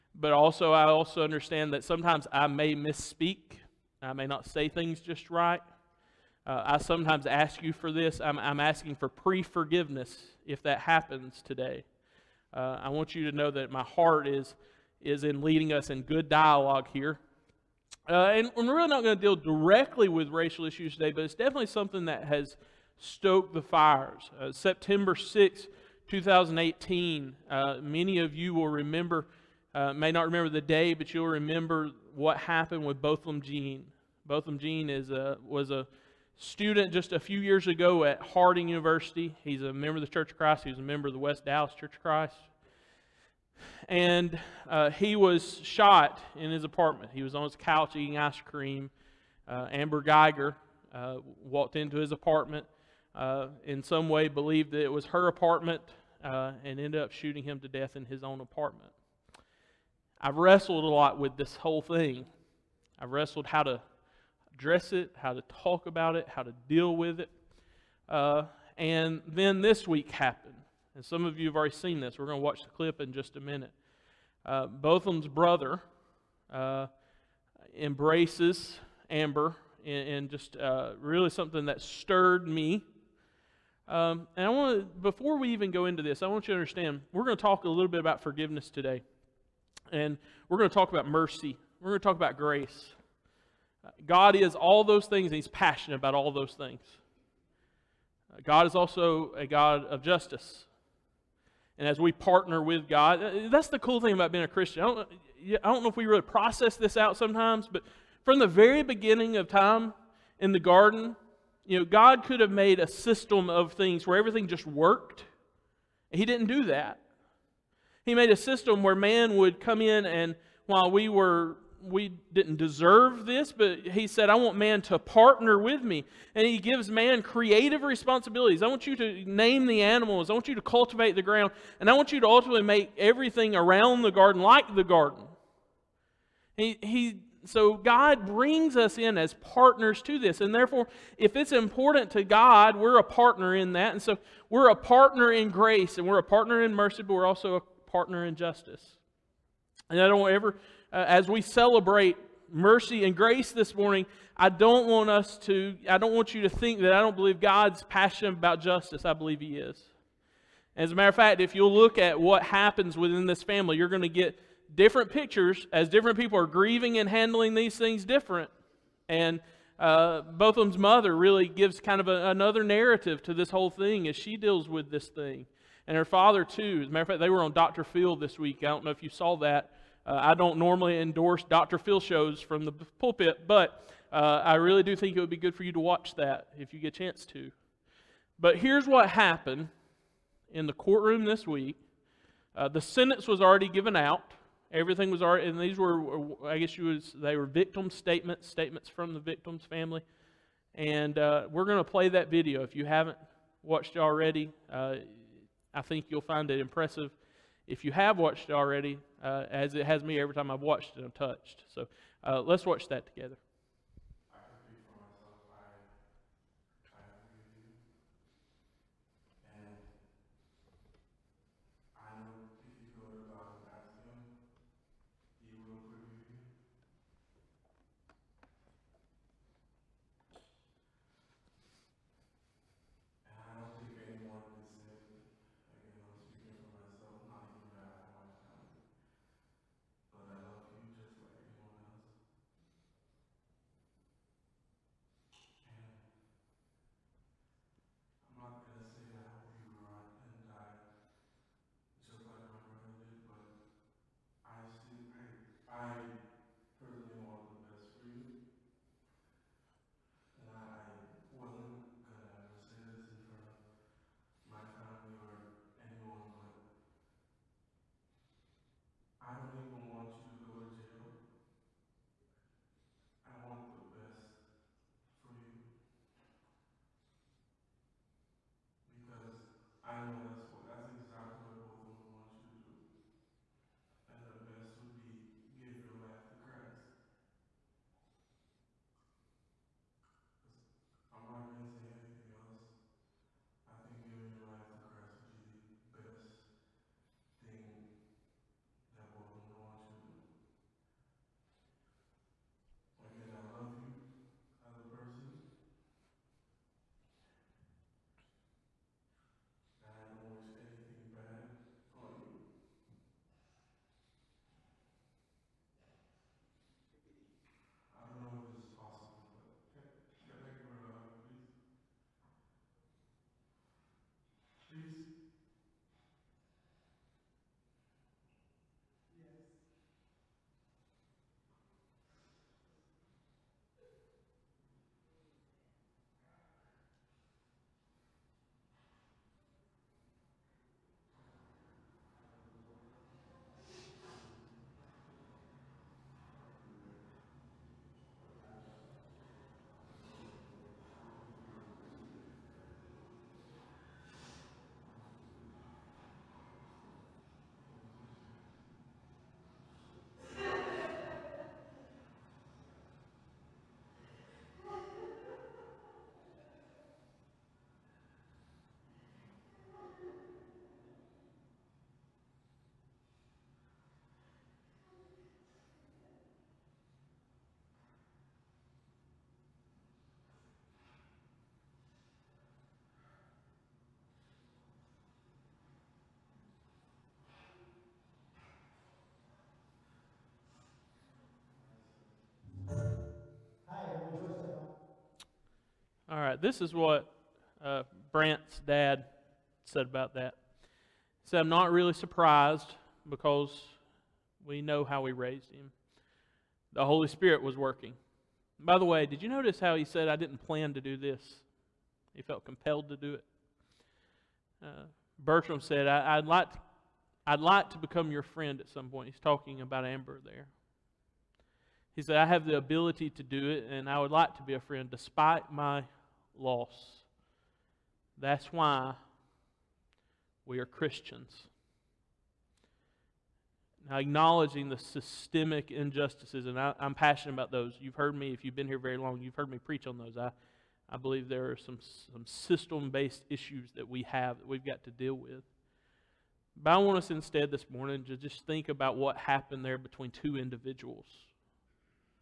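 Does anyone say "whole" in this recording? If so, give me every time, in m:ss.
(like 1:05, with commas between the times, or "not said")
1:01, 2:53.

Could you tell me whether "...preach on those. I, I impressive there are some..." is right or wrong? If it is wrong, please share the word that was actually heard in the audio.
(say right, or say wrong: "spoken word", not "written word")
wrong: "believe", not "impressive".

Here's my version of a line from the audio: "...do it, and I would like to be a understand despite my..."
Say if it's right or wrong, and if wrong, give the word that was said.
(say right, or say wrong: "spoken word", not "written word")
wrong: "friend", not "understand".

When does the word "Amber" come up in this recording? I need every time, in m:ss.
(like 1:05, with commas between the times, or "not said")
0:49, 1:19, 6:59.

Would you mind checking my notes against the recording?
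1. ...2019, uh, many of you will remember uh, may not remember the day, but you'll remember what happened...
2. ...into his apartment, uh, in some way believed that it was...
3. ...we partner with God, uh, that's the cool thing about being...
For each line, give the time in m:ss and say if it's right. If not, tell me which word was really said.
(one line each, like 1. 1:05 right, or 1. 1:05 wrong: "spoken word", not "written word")
1. 0:26 wrong: "2018", not "2019"
2. 0:51 right
3. 1:41 right.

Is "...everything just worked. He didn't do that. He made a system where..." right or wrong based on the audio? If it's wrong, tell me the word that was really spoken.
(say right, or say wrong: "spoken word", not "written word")
right.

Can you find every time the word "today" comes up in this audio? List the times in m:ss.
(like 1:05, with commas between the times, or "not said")
0:11, 0:20, 1:28.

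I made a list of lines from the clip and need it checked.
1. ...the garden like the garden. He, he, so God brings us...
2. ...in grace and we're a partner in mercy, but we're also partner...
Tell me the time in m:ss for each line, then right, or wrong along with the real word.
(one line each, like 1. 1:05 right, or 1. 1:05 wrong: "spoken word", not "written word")
1. 2:14 right
2. 2:25 right.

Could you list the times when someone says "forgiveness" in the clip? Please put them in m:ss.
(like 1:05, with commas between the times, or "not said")
0:09, 1:28.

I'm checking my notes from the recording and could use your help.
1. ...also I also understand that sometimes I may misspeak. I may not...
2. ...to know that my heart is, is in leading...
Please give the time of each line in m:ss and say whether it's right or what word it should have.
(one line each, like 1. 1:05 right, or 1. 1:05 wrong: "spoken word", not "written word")
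1. 0:00 right
2. 0:13 right.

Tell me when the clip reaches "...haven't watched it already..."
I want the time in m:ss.
3:22.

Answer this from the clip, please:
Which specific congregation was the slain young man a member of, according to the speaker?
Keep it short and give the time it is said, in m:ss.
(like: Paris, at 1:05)
West Dallas Church of Christ, at 0:41.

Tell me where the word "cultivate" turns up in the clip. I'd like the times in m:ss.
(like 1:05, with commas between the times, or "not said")
2:10.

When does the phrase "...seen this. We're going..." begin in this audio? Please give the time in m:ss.
1:11.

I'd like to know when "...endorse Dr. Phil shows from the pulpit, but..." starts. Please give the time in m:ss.
3:00.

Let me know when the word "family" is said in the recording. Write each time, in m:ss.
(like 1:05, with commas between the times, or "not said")
2:43, 3:19.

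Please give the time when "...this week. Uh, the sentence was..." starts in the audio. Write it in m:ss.
3:11.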